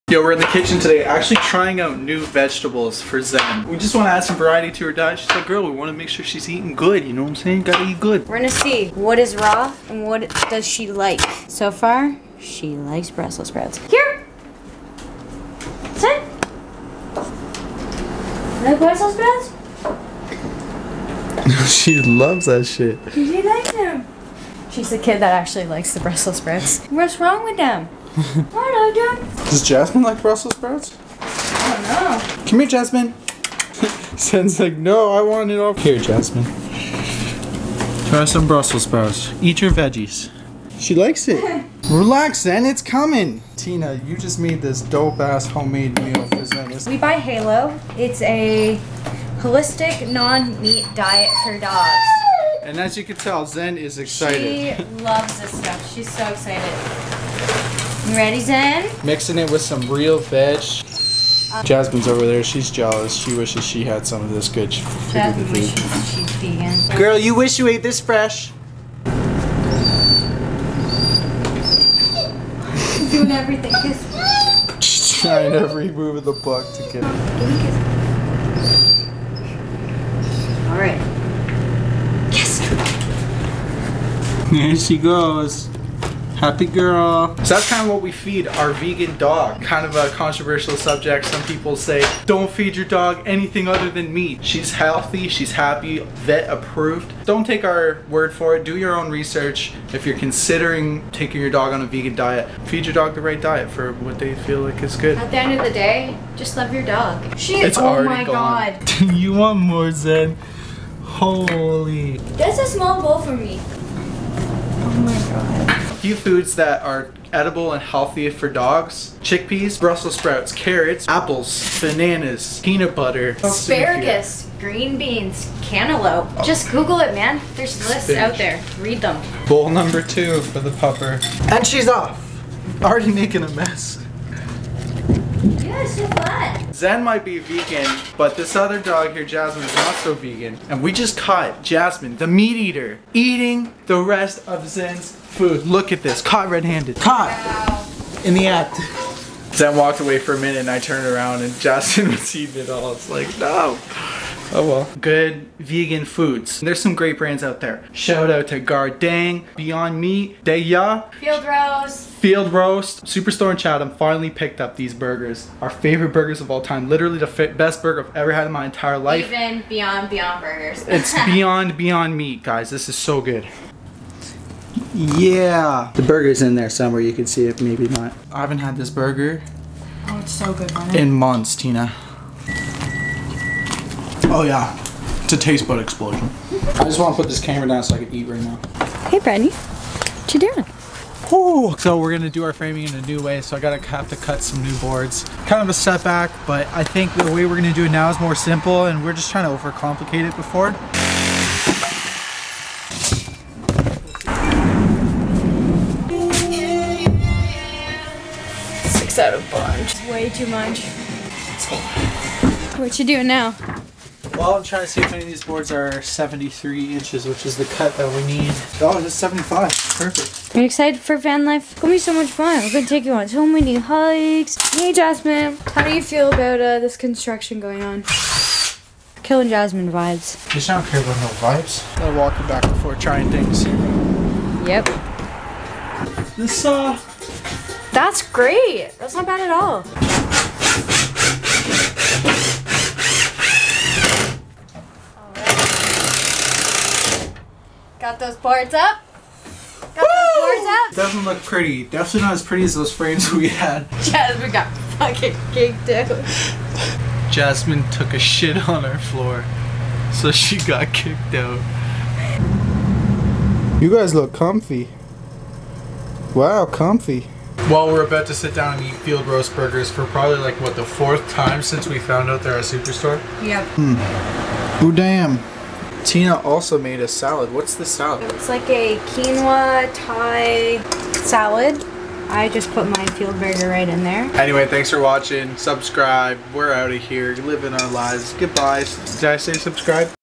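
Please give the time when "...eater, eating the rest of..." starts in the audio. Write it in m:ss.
2:22.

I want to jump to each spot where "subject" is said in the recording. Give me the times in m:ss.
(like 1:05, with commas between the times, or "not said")
1:30.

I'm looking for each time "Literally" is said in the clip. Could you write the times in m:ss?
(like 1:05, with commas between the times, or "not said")
2:46.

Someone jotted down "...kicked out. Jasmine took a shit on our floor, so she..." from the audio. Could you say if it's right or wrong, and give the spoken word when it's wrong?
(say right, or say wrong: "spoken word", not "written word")
right.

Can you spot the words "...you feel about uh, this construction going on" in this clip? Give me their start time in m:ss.
3:45.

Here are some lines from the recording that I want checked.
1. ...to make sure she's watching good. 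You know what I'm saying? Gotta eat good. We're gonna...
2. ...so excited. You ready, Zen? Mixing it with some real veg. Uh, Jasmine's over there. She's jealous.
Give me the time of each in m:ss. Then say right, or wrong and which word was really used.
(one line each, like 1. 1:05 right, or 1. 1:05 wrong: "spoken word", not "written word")
1. 0:05 wrong: "eating", not "watching"
2. 0:56 right.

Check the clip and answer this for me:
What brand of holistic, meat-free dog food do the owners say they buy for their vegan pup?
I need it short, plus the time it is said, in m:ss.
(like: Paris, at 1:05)
Halo, at 0:47.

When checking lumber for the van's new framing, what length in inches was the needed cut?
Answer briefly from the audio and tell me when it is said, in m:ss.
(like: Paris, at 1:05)
73 inches, at 3:36.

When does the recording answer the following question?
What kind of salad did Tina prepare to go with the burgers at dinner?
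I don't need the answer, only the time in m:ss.
4:38.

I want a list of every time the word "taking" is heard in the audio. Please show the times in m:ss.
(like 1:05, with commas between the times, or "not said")
1:41.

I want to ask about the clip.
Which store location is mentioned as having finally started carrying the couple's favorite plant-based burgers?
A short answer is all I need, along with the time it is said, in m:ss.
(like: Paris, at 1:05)
Chatham, at 2:43.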